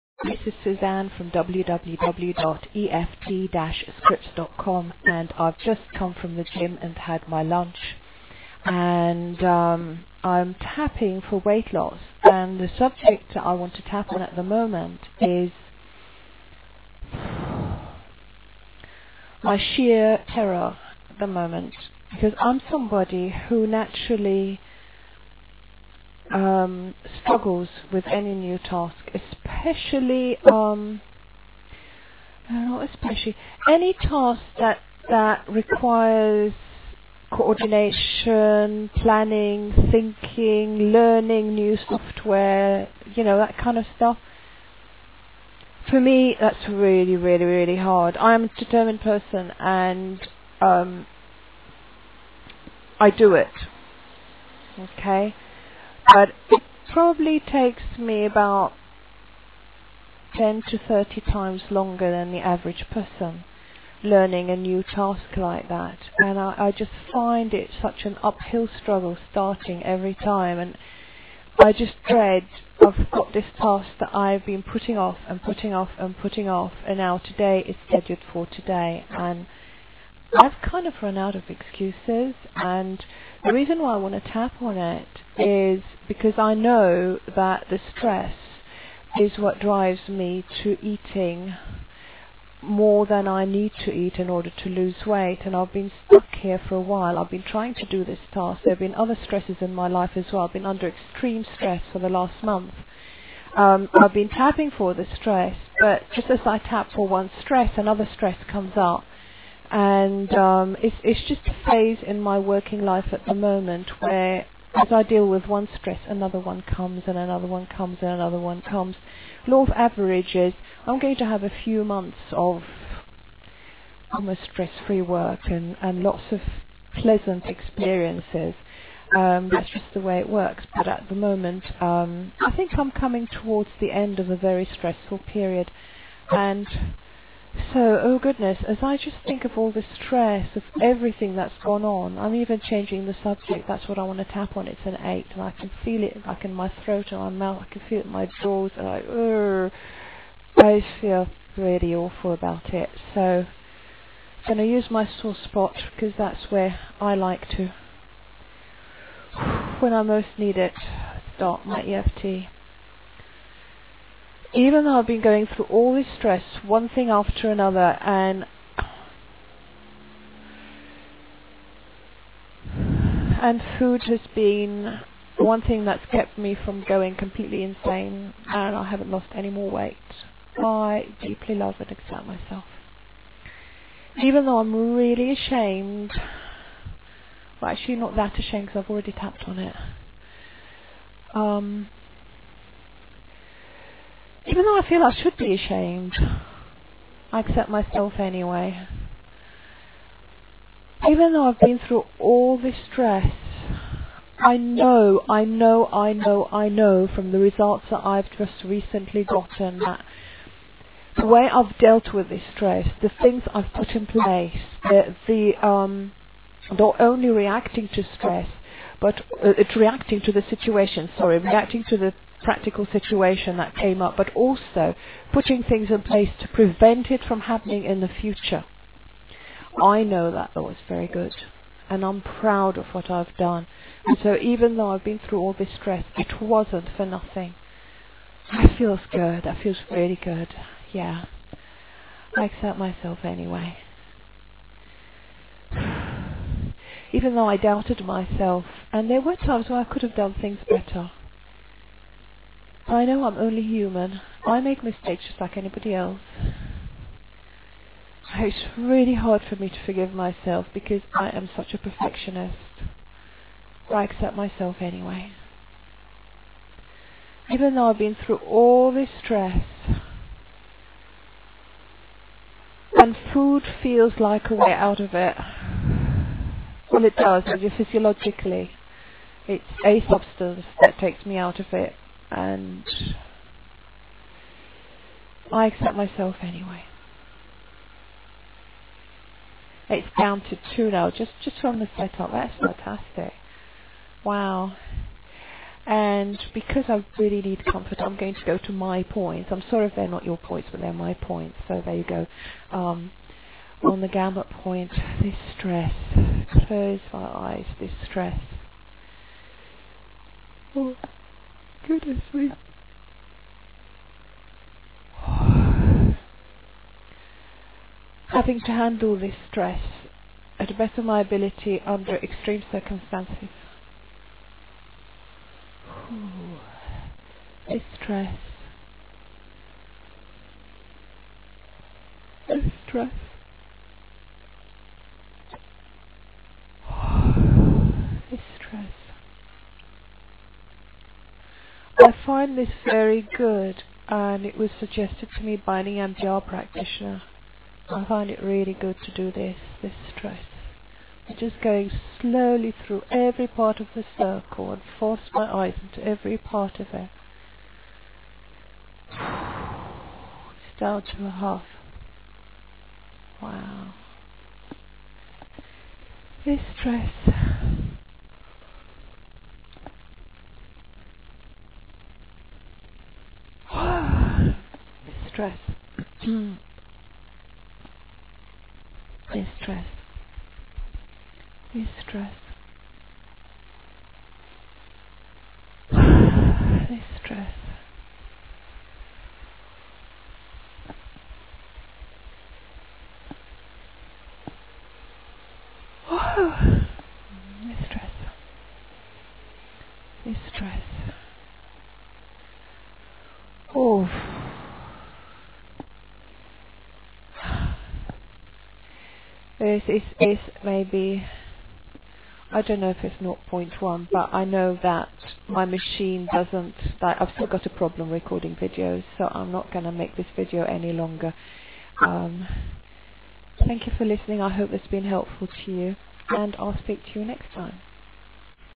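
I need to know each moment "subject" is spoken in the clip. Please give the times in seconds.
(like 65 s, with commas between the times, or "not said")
12 s, 143 s.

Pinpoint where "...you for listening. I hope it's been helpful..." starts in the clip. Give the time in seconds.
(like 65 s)
423 s.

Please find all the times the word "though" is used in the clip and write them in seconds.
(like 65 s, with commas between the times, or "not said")
164 s, 184 s, 194 s, 201 s, 234 s, 247 s, 267 s.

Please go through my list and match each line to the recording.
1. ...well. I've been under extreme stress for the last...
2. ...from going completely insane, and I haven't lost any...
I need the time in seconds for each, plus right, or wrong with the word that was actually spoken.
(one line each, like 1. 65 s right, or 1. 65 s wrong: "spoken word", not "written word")
1. 100 s right
2. 176 s right.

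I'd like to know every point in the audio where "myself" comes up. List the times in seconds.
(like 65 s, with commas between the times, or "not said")
182 s, 197 s, 242 s, 248 s, 260 s, 264 s, 285 s.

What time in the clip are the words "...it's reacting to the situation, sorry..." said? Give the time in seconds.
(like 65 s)
219 s.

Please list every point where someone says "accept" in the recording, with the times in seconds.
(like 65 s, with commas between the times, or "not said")
181 s, 197 s, 242 s, 264 s, 285 s.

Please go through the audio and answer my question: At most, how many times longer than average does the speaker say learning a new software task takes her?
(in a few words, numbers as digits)
30.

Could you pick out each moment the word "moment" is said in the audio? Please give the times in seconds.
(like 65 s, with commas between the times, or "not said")
14 s, 21 s, 113 s, 131 s.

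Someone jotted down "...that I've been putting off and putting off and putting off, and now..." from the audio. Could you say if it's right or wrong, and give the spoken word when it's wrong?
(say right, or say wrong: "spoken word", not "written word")
right.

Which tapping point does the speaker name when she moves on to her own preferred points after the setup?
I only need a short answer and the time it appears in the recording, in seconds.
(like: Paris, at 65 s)
Gamut point, at 304 s.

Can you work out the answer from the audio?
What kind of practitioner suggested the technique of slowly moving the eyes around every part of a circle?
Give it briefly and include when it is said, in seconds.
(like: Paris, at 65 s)
EMDR practitioner, at 345 s.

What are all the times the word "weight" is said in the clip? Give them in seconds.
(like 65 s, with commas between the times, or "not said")
11 s, 95 s, 179 s.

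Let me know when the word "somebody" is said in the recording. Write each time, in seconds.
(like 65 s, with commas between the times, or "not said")
22 s.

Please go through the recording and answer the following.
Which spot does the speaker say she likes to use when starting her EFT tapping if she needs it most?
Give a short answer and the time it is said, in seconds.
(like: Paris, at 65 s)
Sore spot, at 155 s.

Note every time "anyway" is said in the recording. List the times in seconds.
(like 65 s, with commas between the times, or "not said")
198 s, 243 s, 264 s, 286 s.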